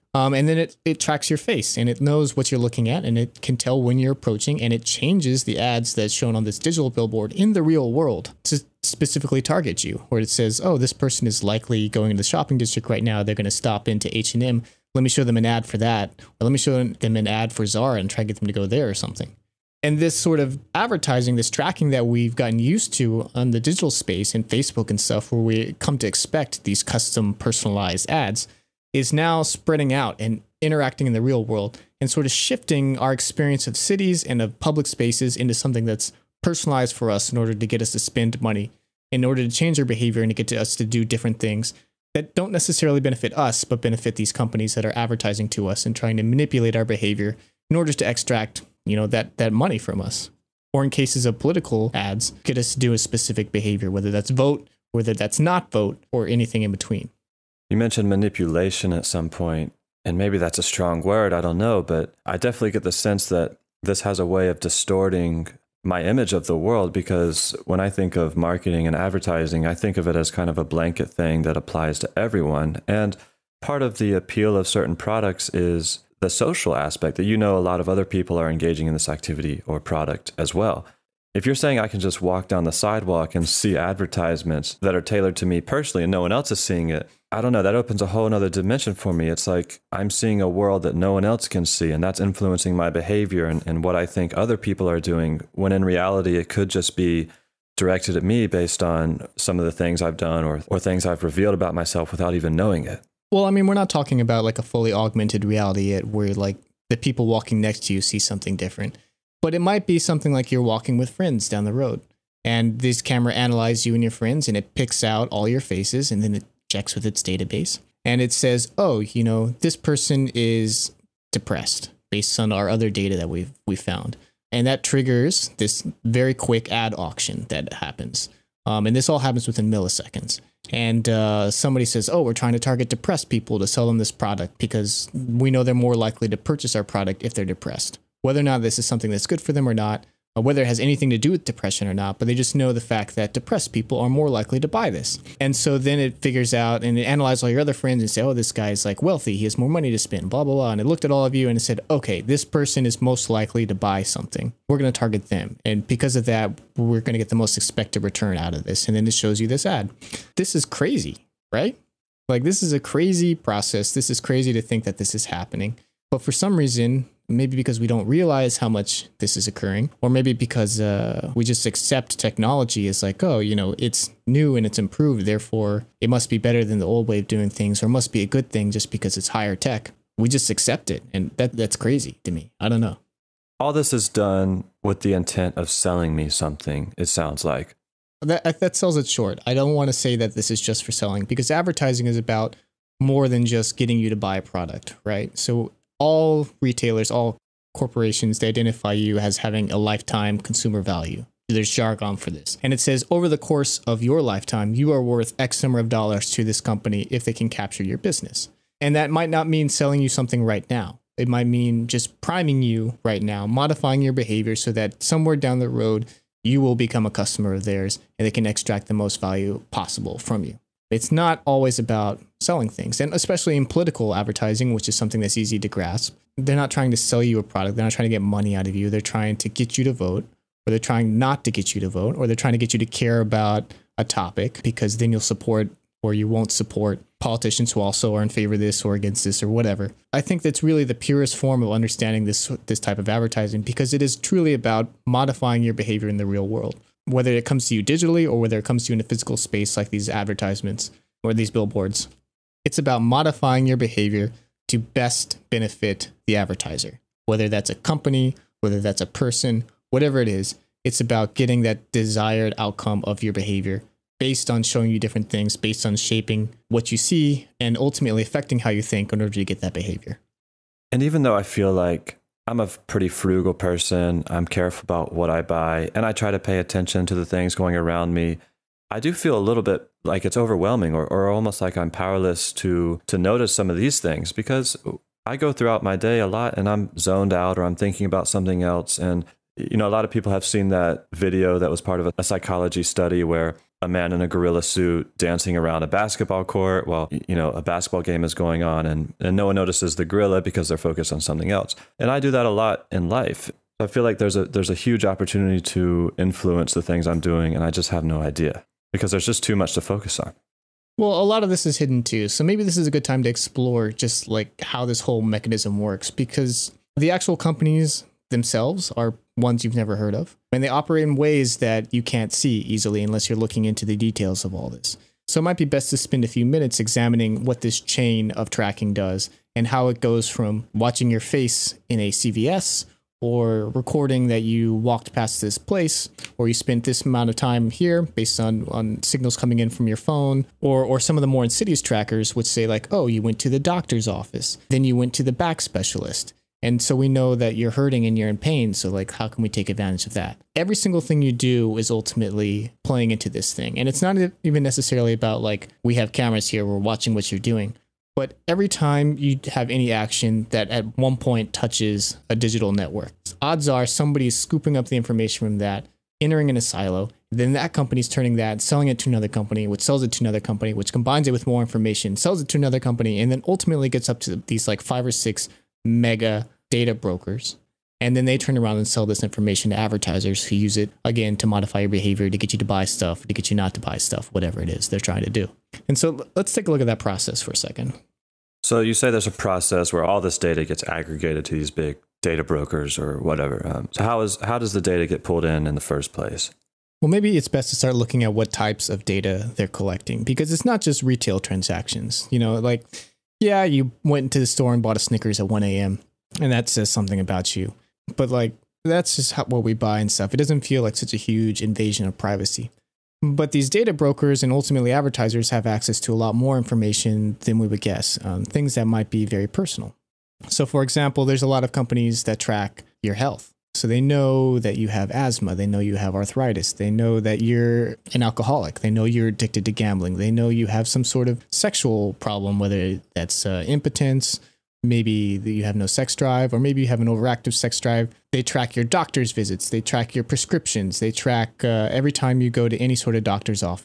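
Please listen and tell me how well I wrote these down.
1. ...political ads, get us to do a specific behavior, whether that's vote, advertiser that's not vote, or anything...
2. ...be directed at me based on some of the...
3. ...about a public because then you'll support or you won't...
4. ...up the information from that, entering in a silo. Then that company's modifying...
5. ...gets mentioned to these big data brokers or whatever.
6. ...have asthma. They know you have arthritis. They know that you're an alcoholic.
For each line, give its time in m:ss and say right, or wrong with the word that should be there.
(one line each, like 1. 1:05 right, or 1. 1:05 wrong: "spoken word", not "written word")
1. 0:51 wrong: "whether", not "advertiser"
2. 1:36 right
3. 3:53 wrong: "topic", not "public"
4. 6:04 wrong: "turning", not "modifying"
5. 6:30 wrong: "aggregated", not "mentioned"
6. 7:04 right.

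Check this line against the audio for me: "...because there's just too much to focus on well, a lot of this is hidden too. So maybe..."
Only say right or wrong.
right.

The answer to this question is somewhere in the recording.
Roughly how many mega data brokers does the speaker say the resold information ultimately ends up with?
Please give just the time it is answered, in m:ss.
6:14.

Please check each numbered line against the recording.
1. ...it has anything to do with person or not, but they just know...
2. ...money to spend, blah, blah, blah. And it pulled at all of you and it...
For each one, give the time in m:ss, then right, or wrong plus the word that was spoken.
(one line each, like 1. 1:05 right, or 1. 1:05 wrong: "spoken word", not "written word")
1. 2:20 wrong: "depression", not "person"
2. 2:29 wrong: "looked", not "pulled".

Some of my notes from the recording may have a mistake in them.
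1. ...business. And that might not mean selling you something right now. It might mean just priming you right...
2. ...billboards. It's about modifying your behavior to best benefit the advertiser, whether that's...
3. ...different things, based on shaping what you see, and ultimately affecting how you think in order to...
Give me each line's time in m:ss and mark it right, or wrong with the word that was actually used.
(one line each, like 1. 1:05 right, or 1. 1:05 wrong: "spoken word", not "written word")
1. 3:27 right
2. 4:11 right
3. 4:24 right.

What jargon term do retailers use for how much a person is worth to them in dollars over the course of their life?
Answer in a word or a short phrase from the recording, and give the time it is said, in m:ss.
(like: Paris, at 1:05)
lifetime consumer value, at 3:19.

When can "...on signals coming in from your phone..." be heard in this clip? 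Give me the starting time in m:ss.
5:38.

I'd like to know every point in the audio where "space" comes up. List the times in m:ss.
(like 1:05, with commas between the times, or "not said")
0:23, 0:34, 4:09.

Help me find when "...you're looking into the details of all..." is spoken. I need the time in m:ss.
5:23.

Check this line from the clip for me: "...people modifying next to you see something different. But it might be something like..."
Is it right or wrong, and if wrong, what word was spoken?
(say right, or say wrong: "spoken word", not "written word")
wrong: "walking", not "modifying".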